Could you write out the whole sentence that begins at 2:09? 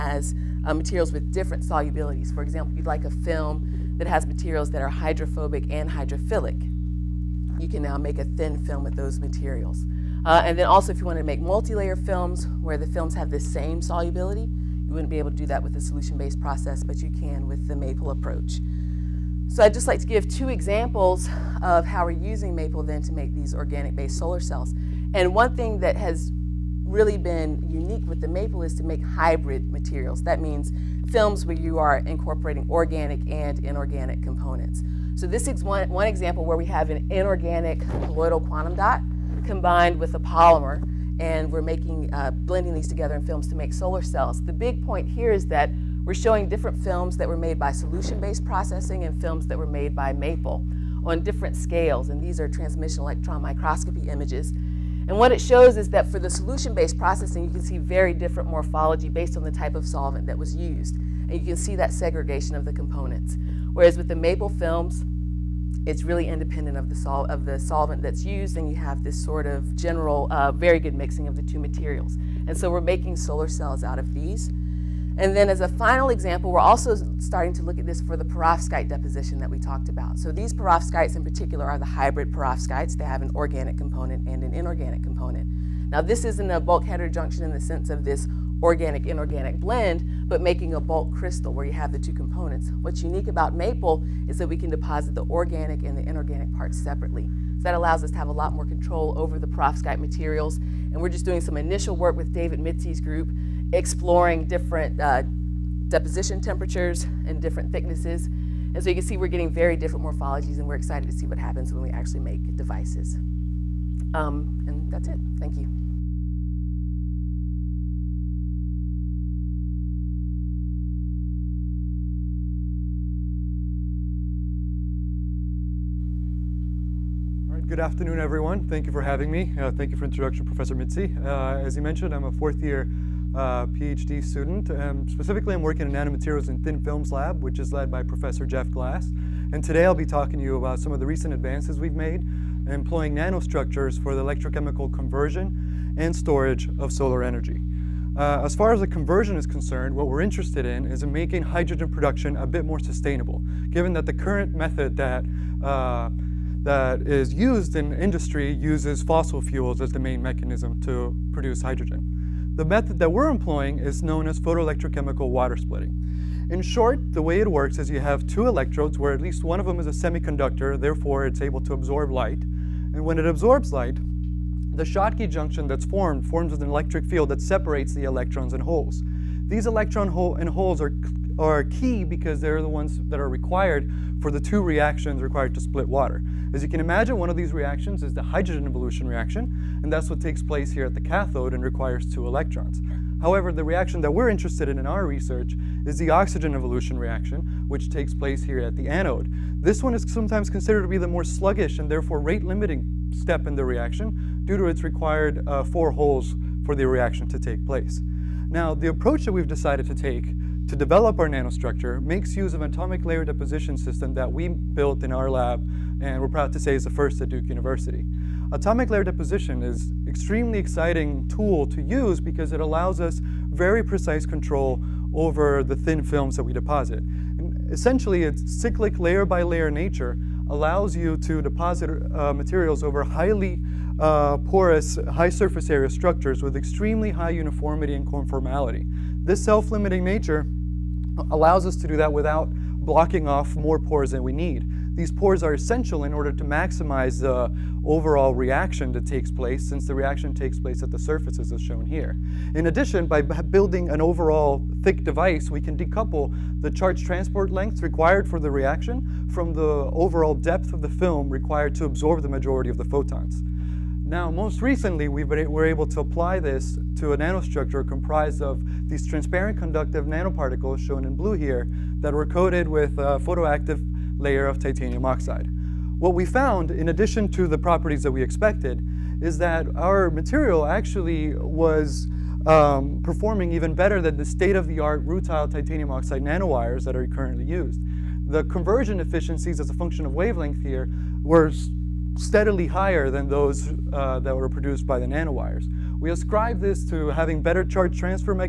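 Uh, thank you for introduction, Professor Mitzi.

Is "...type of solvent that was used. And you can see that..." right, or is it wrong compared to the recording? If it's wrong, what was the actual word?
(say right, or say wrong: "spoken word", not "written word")
right.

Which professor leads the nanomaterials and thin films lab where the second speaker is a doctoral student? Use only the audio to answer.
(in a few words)
Jeff Glass.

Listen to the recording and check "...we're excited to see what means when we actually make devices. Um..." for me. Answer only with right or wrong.
wrong.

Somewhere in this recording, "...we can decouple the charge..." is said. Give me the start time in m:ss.
4:15.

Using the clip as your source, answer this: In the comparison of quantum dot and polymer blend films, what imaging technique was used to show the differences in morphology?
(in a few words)
transmission electron microscopy.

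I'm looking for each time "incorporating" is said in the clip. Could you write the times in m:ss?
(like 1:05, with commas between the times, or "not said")
0:32.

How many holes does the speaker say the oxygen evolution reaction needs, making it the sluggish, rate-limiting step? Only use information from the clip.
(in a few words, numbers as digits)
4.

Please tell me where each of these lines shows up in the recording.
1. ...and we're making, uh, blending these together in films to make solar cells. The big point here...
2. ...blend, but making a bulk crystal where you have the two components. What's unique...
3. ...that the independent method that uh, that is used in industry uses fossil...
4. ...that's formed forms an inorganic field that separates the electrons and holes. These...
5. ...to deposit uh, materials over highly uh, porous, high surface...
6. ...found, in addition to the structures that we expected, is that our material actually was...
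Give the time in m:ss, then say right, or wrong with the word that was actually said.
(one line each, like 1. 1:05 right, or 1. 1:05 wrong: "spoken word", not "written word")
1. 0:41 right
2. 1:29 right
3. 2:33 wrong: "current", not "independent"
4. 2:55 wrong: "electric", not "inorganic"
5. 3:51 right
6. 4:36 wrong: "properties", not "structures".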